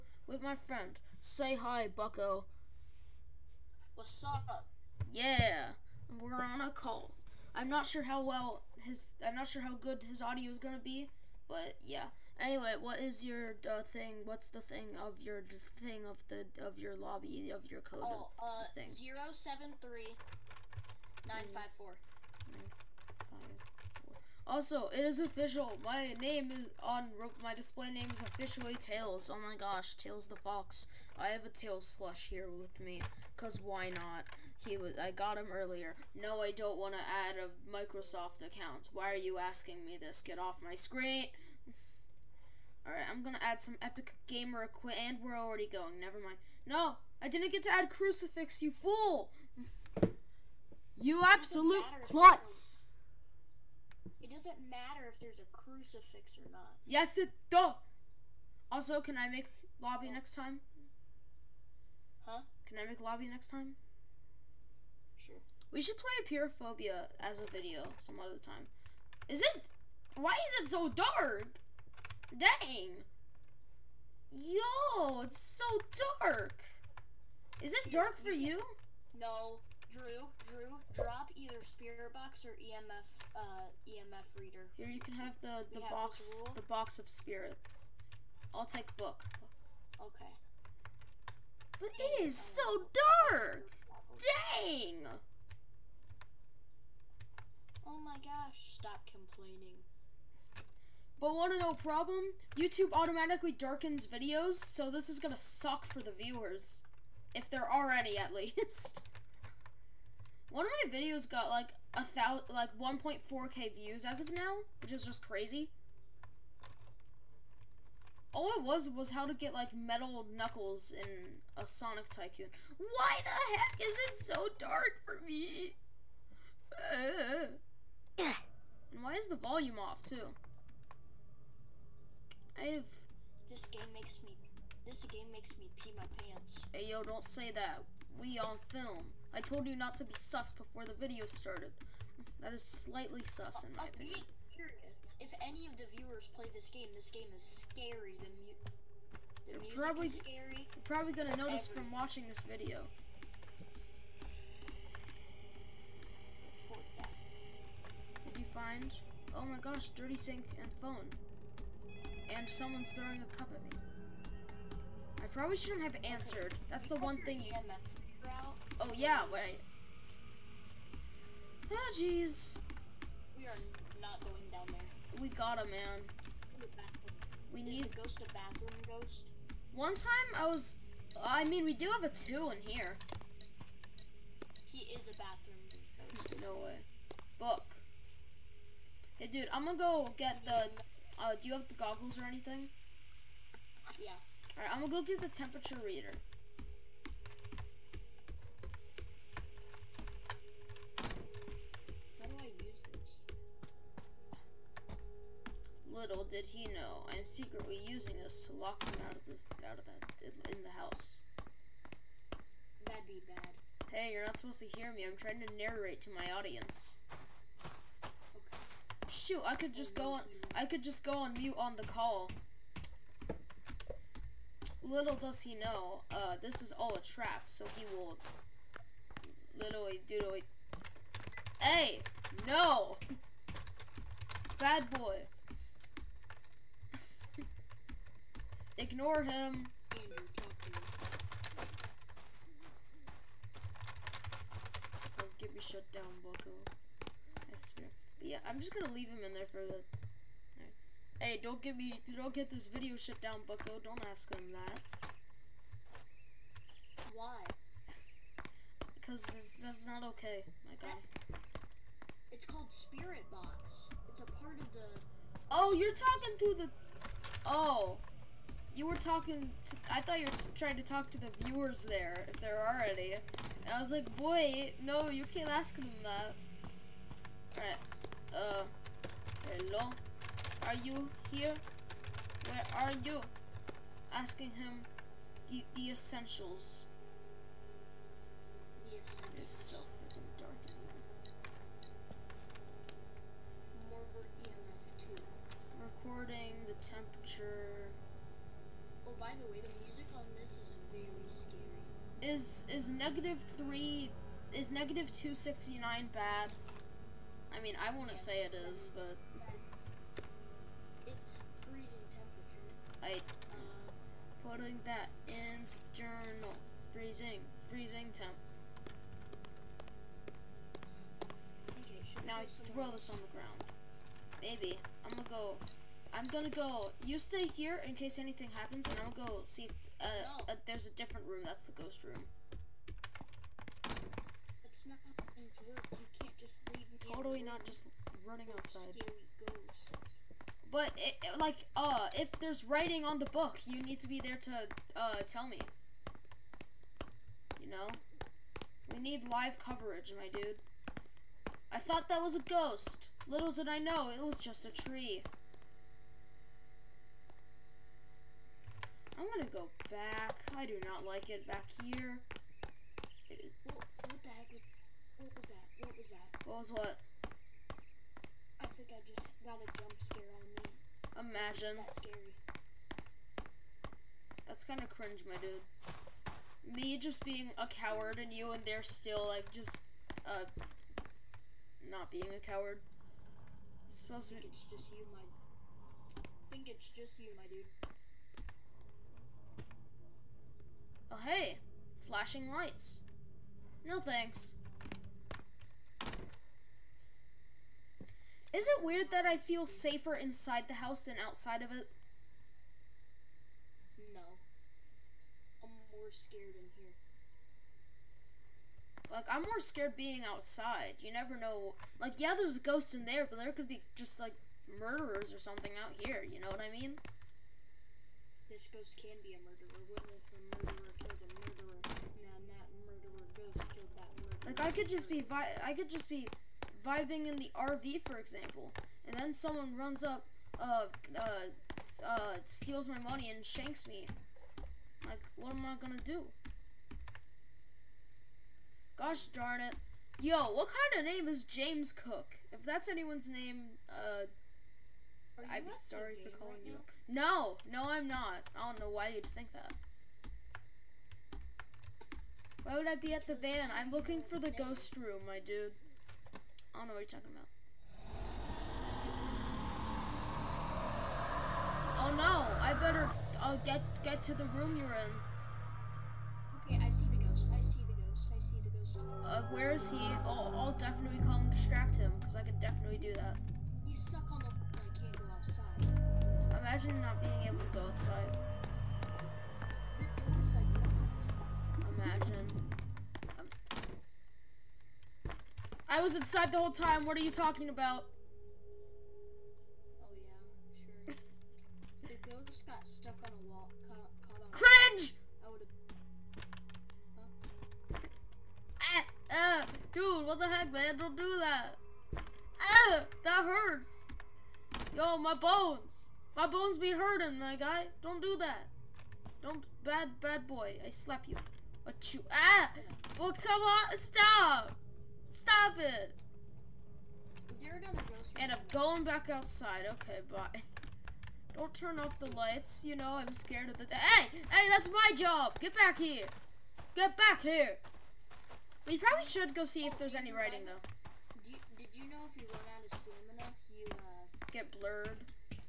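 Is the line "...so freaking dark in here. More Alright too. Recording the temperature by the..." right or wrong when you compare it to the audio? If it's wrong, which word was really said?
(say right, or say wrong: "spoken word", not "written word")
wrong: "EMF", not "Alright".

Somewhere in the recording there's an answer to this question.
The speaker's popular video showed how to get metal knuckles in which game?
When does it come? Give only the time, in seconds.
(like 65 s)
121 s.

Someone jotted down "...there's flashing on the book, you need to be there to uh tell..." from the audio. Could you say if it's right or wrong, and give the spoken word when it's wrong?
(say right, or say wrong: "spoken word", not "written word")
wrong: "writing", not "flashing".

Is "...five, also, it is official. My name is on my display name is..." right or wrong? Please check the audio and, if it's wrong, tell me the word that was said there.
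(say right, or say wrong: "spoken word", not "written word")
right.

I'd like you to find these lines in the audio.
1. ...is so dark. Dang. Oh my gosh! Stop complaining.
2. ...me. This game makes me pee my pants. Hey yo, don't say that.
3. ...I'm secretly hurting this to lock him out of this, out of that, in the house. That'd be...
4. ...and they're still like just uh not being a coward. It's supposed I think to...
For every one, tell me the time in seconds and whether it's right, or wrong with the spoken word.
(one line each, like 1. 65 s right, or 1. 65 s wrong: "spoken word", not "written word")
1. 92 s right
2. 134 s right
3. 207 s wrong: "using", not "hurting"
4. 378 s right.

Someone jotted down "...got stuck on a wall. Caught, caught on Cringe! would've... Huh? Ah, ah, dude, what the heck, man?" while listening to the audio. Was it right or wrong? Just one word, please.
right.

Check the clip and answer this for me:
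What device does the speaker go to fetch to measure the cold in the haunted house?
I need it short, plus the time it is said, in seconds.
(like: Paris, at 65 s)
temperature reader, at 195 s.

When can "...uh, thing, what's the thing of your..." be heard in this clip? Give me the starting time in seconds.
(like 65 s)
13 s.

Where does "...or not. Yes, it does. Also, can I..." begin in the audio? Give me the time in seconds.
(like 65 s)
56 s.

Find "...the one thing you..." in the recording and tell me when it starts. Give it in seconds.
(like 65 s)
166 s.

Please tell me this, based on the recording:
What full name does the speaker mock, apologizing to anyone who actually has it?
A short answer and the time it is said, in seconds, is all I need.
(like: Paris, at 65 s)
James Cook, at 441 s.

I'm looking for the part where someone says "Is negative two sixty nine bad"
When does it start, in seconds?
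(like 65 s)
304 s.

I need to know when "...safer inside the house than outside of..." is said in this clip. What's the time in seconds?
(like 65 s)
399 s.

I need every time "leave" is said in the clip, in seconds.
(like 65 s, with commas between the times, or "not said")
248 s, 336 s.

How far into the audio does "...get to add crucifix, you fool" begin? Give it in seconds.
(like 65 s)
47 s.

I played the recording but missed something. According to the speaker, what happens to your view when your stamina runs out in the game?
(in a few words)
get blurred.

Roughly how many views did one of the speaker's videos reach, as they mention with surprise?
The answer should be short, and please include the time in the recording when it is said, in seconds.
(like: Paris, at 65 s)
1.4k, at 112 s.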